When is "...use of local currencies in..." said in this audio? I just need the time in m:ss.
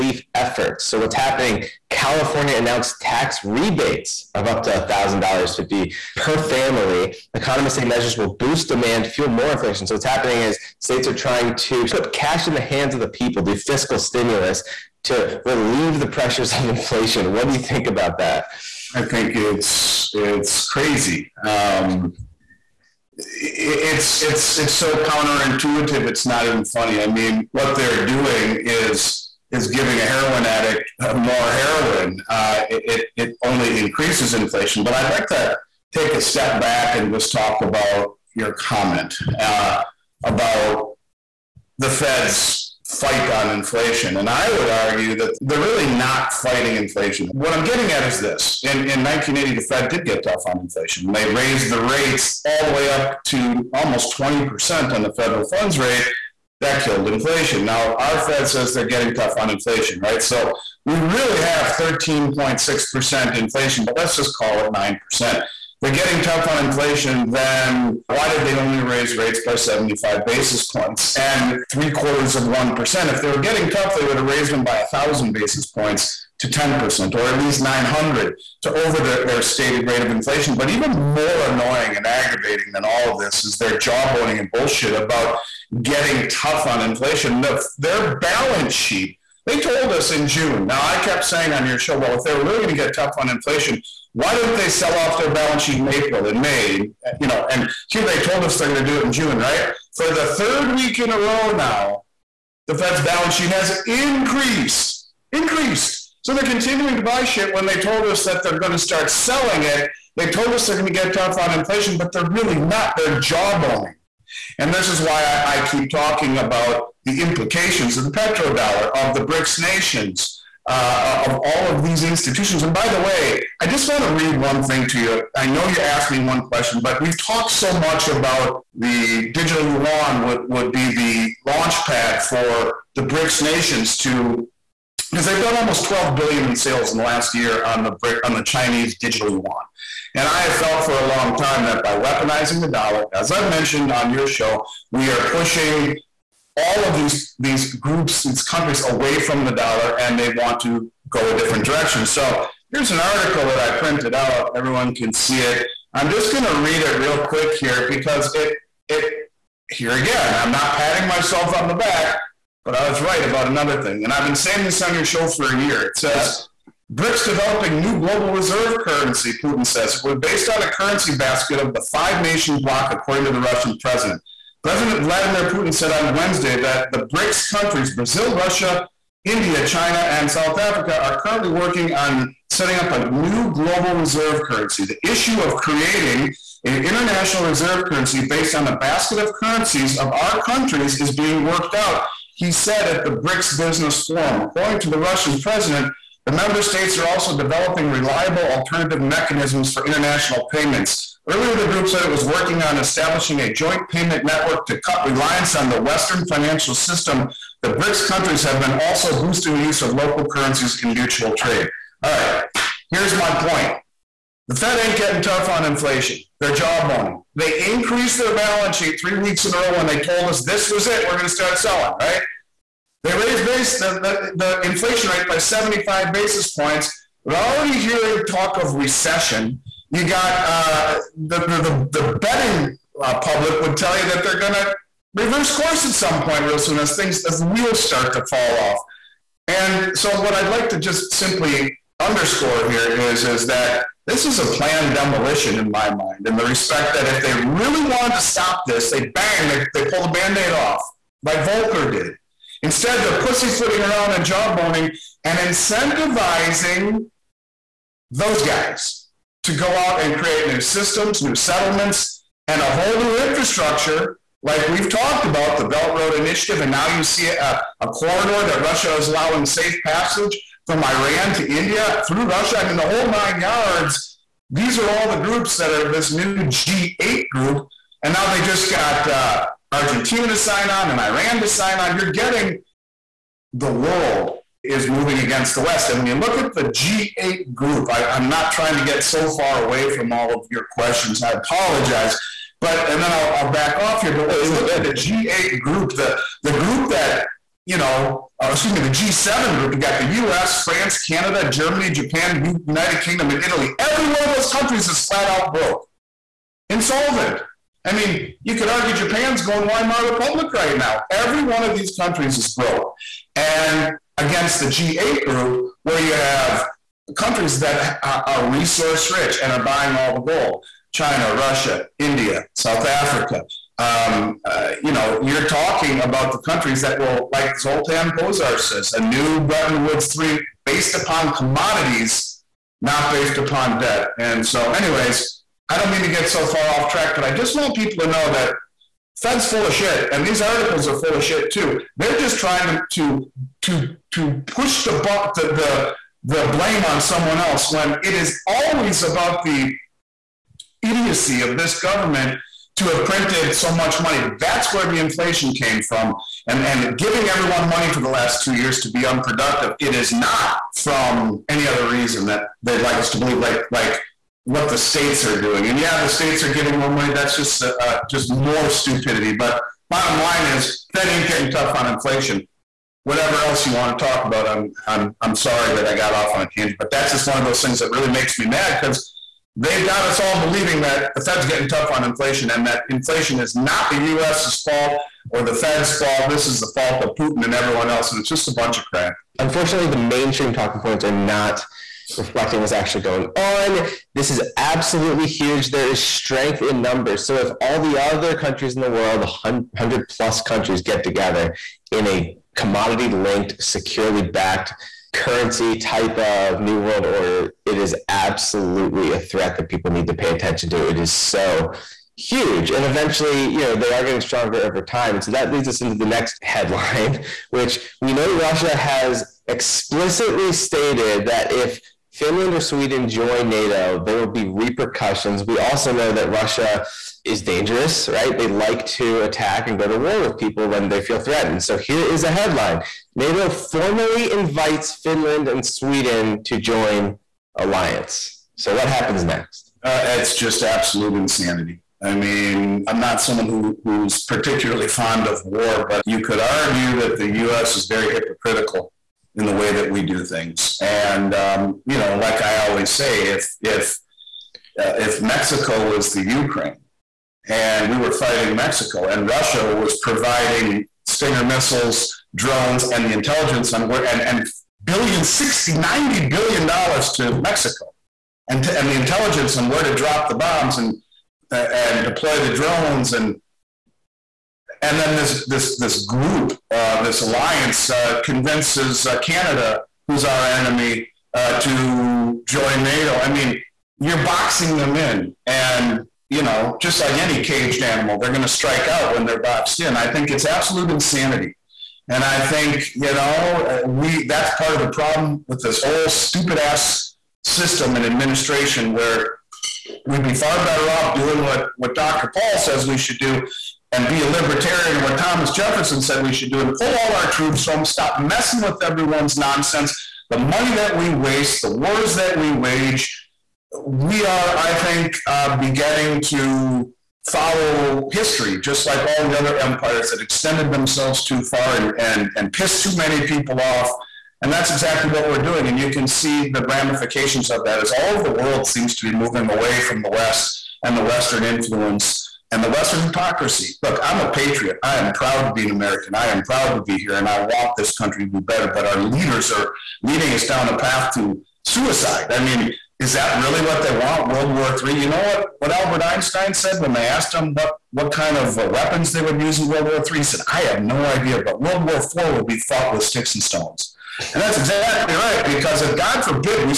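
3:29.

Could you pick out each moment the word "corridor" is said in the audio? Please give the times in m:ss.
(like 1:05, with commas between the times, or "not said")
4:27.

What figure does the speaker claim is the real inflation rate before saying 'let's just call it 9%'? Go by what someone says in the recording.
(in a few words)
13.6%.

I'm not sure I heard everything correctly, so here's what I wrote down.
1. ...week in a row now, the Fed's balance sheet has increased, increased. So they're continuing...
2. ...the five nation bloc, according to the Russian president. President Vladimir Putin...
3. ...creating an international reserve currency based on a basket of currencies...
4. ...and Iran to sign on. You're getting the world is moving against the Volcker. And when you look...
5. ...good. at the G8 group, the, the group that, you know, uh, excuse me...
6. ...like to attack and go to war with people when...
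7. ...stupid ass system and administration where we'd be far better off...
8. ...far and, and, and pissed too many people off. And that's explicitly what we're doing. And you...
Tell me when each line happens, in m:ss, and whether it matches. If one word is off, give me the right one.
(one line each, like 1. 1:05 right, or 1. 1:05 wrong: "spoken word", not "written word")
1. 1:40 right
2. 2:51 right
3. 3:05 right
4. 4:40 wrong: "West", not "Volcker"
5. 4:54 right
6. 7:08 right
7. 8:16 right
8. 8:41 wrong: "exactly", not "explicitly".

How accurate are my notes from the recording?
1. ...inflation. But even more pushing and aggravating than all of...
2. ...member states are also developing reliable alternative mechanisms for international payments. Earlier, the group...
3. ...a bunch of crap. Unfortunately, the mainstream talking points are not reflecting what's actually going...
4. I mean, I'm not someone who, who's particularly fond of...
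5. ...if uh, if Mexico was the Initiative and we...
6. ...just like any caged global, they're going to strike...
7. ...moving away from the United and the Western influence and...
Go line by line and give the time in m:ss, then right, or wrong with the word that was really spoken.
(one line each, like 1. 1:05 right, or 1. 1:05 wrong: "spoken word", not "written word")
1. 1:20 wrong: "annoying", not "pushing"
2. 3:16 right
3. 6:28 right
4. 7:22 right
5. 7:33 wrong: "Ukraine", not "Initiative"
6. 8:06 wrong: "animal", not "global"
7. 8:49 wrong: "West", not "United".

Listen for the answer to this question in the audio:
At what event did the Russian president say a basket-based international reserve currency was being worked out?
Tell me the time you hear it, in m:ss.
3:13.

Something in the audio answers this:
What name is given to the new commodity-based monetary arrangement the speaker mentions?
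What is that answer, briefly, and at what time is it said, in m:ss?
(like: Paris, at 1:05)
Bretton Woods 3, at 5:29.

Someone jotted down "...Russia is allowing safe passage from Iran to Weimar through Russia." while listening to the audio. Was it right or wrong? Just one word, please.
wrong.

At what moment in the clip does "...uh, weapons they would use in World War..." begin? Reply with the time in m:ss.
9:08.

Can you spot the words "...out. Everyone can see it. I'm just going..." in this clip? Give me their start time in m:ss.
2:34.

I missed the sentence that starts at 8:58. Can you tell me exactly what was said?
But our leaders are leading us down a path to suicide.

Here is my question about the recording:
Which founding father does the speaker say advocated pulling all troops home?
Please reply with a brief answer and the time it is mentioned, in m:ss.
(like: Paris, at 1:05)
Thomas Jefferson, at 8:25.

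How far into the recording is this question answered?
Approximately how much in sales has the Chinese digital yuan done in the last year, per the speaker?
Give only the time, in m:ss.
2:15.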